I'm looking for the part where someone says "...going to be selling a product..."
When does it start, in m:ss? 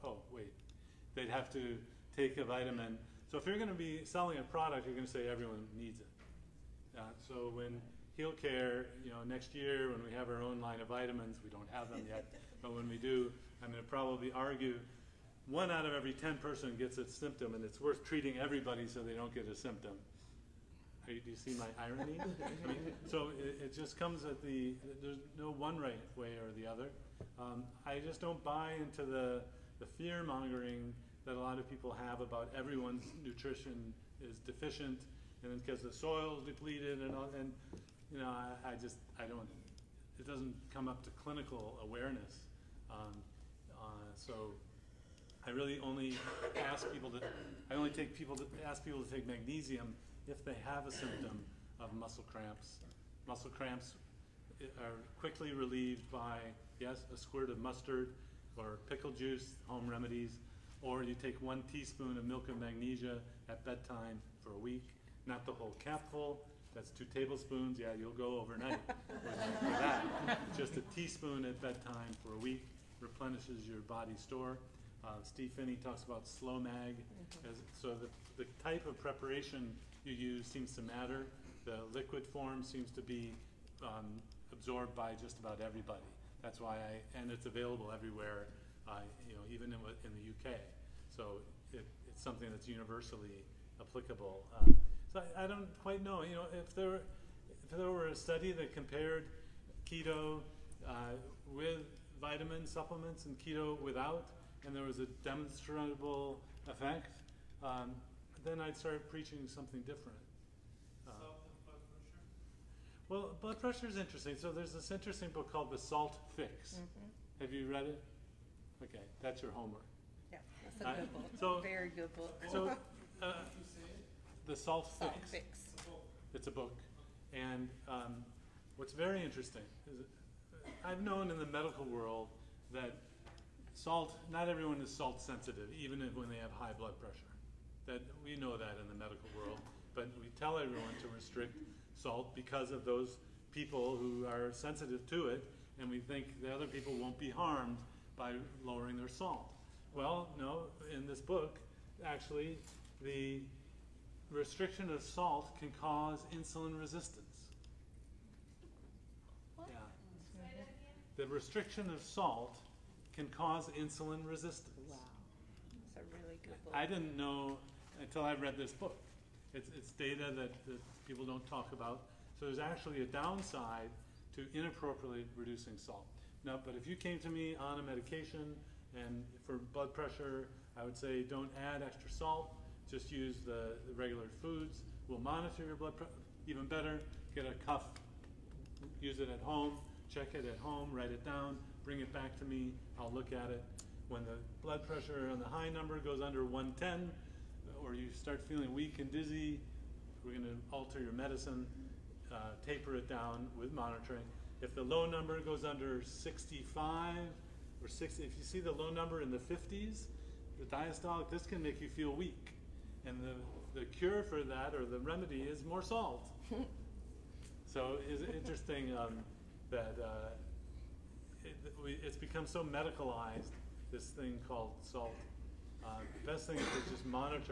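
0:03.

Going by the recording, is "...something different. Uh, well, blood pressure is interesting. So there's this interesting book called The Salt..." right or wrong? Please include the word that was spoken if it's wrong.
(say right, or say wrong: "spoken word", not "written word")
right.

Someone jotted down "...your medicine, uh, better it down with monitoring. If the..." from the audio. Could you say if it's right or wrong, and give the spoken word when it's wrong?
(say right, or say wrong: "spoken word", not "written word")
wrong: "taper", not "better".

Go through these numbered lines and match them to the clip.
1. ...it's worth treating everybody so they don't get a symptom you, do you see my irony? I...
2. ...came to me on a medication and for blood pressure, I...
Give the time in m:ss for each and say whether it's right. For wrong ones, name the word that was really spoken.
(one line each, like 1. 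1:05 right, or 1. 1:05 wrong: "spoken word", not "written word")
1. 0:17 right
2. 2:56 right.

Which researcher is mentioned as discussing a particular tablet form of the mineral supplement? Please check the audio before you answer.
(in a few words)
Steve Phinney.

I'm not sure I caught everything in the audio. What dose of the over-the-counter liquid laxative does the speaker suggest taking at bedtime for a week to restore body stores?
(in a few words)
1 teaspoon.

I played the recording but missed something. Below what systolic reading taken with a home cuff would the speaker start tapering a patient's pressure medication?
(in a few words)
110.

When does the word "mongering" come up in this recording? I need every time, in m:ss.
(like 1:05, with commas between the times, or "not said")
0:30.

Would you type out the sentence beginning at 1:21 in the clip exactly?
The liquid form seems to be um, absorbed by just about everybody.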